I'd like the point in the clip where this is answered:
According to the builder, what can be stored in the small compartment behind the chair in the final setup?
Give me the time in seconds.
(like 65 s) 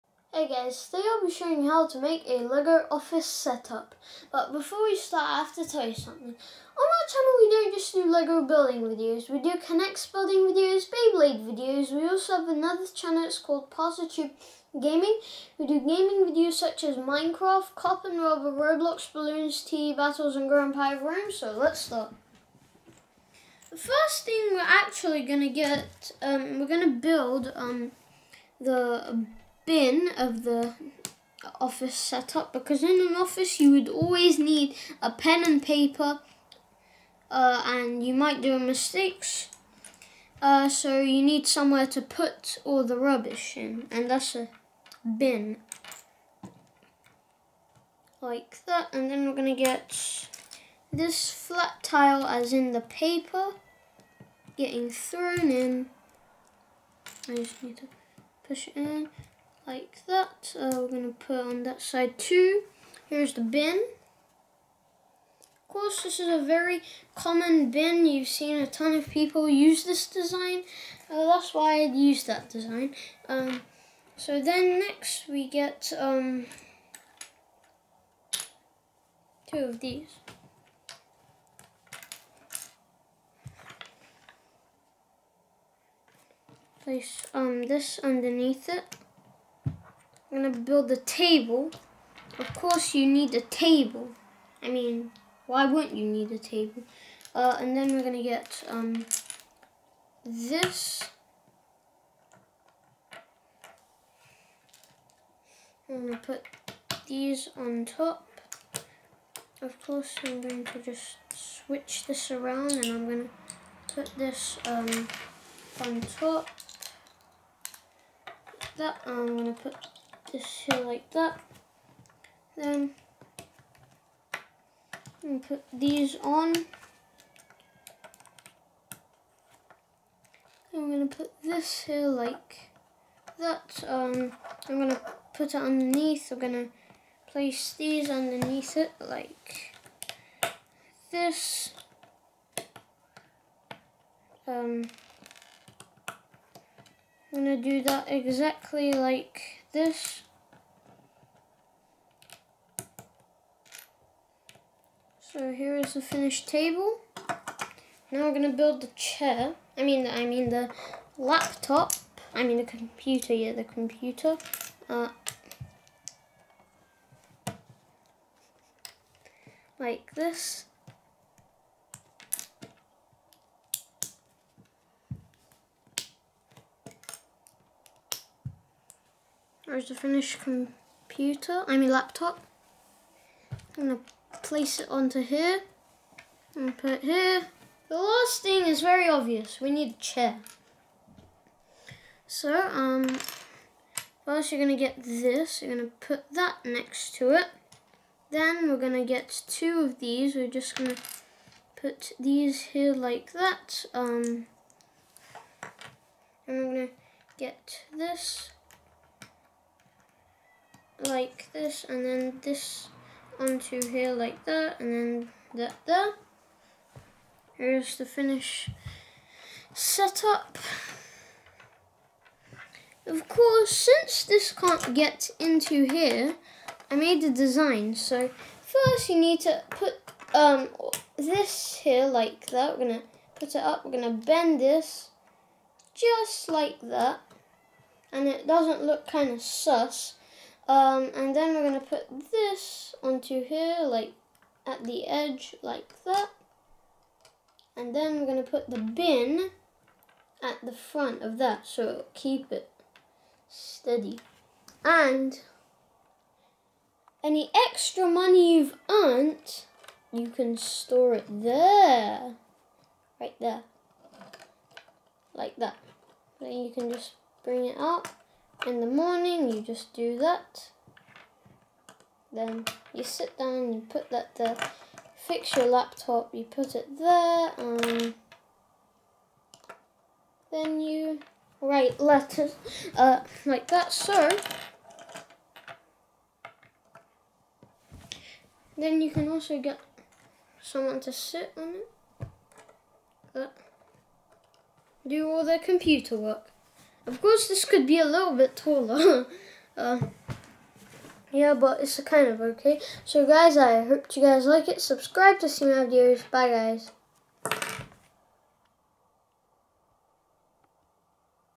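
257 s.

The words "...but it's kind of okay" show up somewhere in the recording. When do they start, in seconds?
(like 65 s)
301 s.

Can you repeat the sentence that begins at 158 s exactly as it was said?
Now we're going to build the chair.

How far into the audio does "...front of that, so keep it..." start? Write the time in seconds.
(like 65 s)
250 s.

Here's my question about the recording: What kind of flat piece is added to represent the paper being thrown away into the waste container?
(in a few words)
flat tile.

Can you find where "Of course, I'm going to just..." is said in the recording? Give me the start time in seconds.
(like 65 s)
109 s.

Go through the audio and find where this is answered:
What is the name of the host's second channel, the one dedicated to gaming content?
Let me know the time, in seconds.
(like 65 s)
13 s.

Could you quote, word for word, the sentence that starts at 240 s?
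Um, and then we're going to put this onto here, like at the edge, like that.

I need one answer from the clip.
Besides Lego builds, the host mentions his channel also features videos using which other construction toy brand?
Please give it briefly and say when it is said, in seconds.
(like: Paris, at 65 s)
K'Nex, at 9 s.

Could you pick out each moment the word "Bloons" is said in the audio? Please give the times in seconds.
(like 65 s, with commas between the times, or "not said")
19 s.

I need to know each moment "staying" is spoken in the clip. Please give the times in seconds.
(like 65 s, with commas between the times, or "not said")
not said.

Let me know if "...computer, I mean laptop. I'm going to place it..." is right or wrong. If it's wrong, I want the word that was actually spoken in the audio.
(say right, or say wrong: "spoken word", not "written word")
right.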